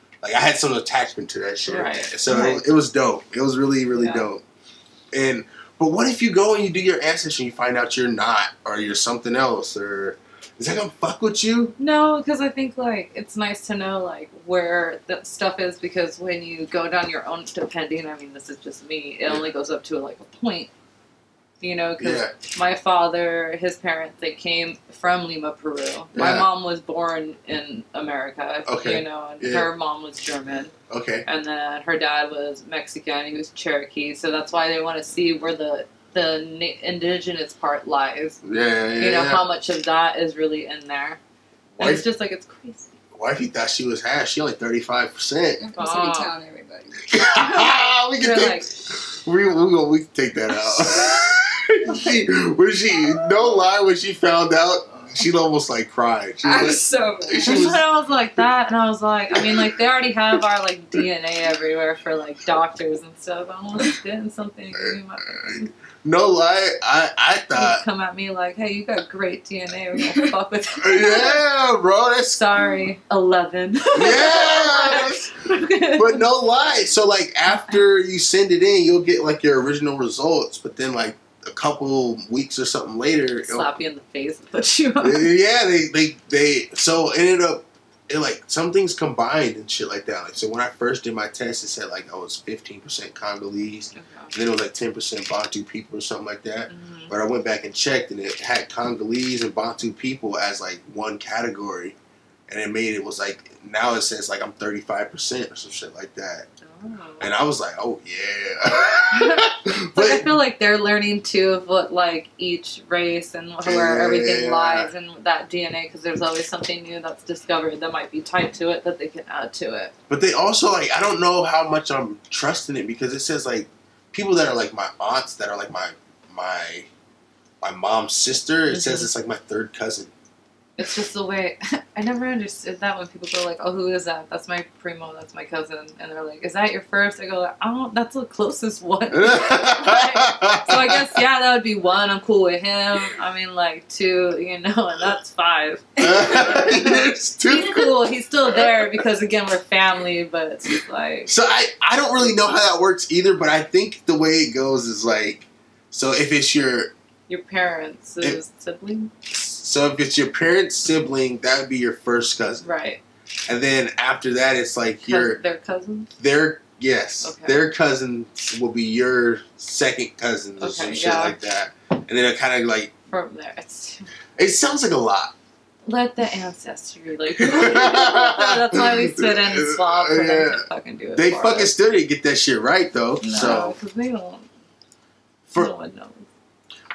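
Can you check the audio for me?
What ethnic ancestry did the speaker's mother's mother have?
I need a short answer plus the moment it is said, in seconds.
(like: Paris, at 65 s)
German, at 30 s.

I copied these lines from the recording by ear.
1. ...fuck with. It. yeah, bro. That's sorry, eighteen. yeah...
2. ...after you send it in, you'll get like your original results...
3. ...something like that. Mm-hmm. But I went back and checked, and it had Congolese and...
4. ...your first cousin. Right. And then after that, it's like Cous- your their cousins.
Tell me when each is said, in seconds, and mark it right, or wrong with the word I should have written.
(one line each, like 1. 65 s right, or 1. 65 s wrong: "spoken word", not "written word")
1. 70 s wrong: "eleven", not "eighteen"
2. 77 s right
3. 96 s right
4. 161 s right.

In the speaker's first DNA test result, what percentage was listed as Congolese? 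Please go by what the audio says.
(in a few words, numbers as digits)
15%.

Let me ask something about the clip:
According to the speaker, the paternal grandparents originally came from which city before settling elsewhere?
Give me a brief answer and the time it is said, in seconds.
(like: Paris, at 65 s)
Lima, Peru, at 25 s.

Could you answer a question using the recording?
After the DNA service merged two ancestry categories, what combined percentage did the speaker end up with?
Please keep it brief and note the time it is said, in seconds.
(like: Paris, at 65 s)
35%, at 104 s.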